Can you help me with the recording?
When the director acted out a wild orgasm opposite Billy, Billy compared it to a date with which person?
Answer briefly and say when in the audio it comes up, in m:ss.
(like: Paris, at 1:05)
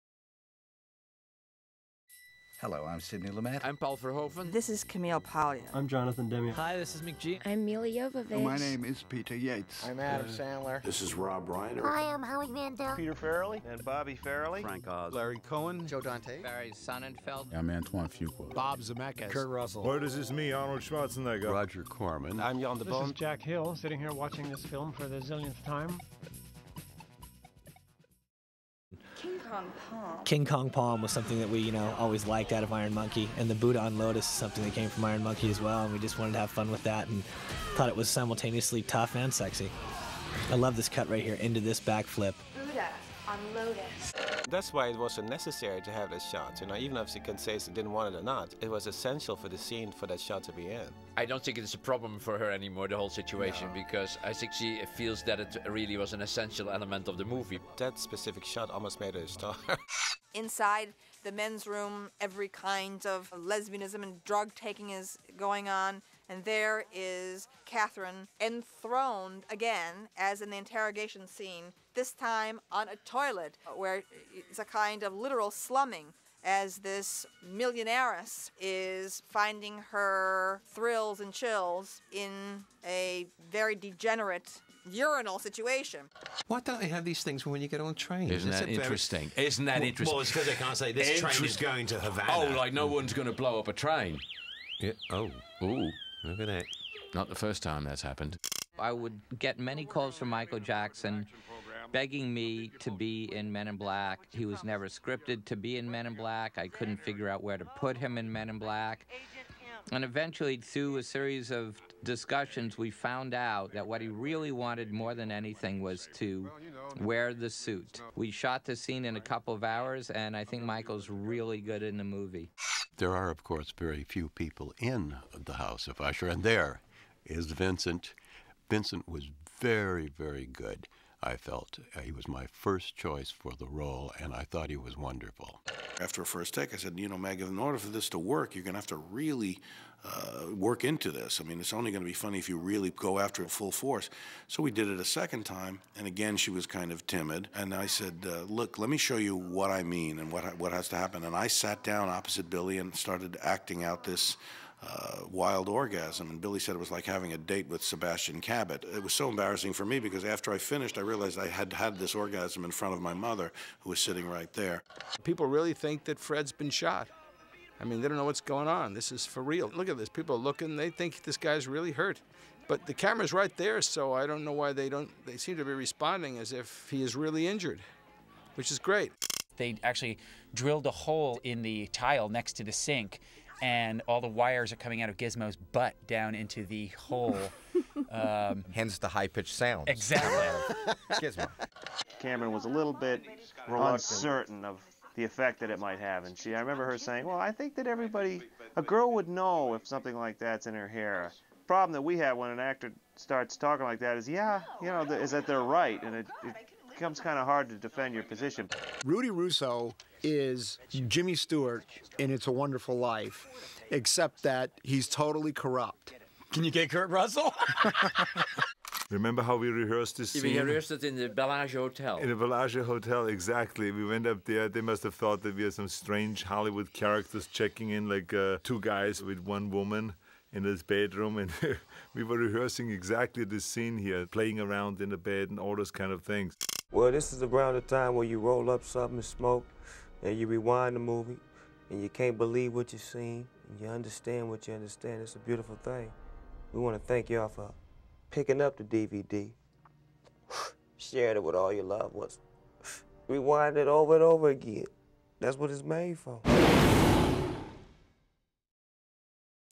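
Sebastian Cabot, at 2:37.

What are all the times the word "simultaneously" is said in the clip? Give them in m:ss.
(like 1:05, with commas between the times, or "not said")
0:38.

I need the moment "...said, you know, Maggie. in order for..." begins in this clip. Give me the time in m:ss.
2:16.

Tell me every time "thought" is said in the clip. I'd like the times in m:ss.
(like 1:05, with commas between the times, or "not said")
0:37, 2:14, 3:45.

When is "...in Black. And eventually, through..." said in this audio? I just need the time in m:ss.
1:48.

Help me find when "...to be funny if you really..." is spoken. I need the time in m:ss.
2:22.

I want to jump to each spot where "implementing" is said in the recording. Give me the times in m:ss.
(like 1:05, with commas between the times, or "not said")
not said.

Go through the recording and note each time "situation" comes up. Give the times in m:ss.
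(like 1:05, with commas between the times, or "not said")
0:53, 1:25.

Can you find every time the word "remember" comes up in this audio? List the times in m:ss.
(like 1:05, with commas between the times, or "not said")
3:16, 3:39.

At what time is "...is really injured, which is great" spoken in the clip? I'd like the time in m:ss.
2:57.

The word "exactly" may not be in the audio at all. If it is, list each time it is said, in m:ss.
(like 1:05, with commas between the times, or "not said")
3:09, 3:43, 3:52.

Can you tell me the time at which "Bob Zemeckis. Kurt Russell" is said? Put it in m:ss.
0:18.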